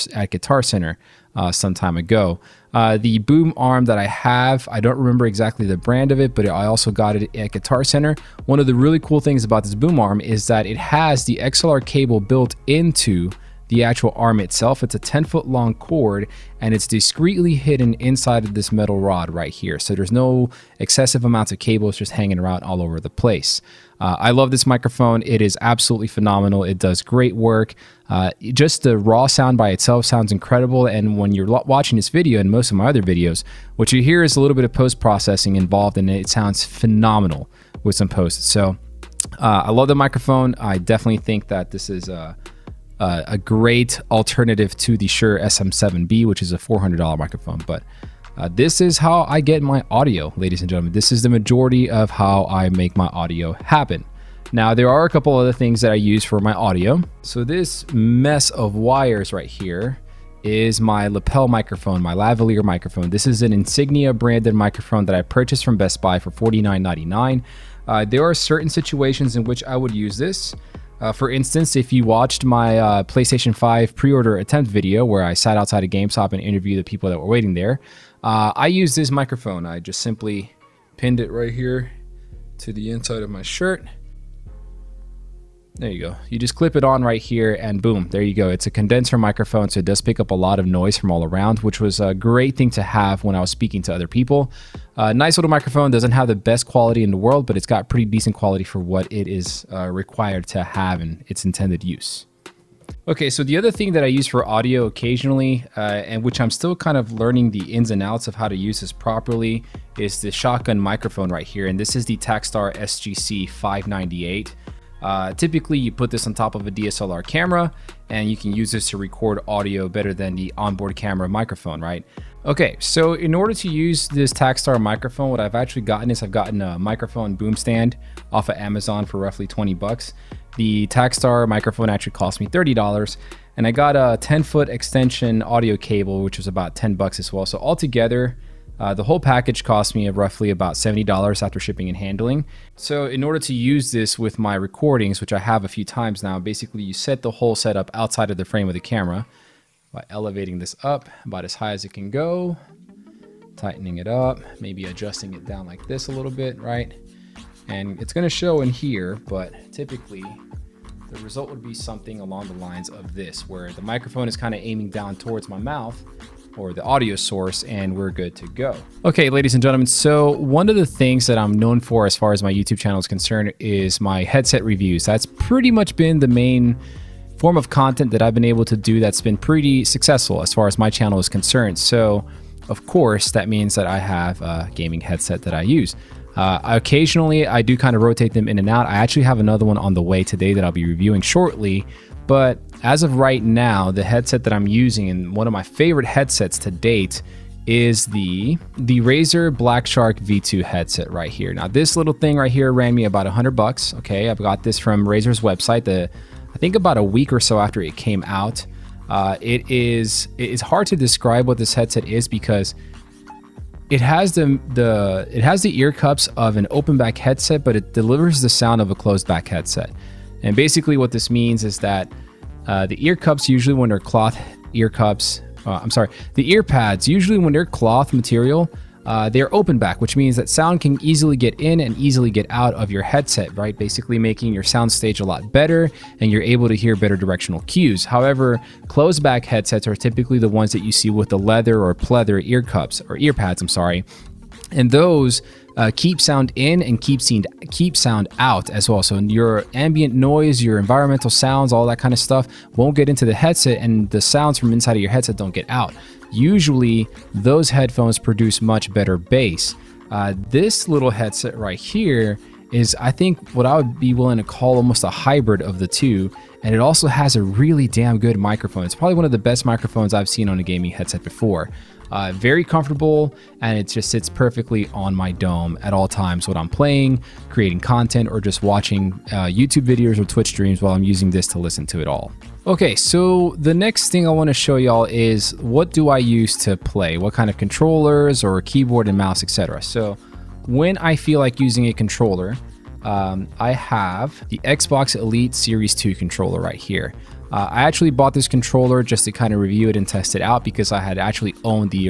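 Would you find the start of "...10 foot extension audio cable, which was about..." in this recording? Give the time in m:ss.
2:14.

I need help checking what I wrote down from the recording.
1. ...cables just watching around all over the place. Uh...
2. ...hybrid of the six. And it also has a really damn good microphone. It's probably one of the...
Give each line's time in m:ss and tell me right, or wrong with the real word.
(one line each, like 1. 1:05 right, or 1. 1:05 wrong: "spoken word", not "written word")
1. 0:21 wrong: "hanging", not "watching"
2. 4:25 wrong: "two", not "six".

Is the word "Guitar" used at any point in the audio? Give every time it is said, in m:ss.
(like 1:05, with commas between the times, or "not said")
0:00, 0:07.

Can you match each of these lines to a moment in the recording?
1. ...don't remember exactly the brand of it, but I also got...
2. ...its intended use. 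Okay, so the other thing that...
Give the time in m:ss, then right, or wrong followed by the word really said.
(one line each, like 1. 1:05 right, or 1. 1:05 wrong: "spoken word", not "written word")
1. 0:04 right
2. 1:41 right.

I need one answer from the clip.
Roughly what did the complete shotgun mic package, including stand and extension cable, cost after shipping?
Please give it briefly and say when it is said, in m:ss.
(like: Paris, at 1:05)
$70, at 2:20.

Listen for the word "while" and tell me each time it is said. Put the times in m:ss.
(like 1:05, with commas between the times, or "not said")
4:40.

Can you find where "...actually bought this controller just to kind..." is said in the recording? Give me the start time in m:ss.
4:57.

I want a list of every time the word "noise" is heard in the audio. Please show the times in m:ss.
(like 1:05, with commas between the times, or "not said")
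1:30, 4:10.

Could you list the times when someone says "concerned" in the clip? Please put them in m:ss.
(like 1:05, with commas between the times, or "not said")
2:53, 3:01.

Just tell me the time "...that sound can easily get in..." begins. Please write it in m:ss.
3:50.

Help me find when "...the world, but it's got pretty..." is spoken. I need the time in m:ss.
1:37.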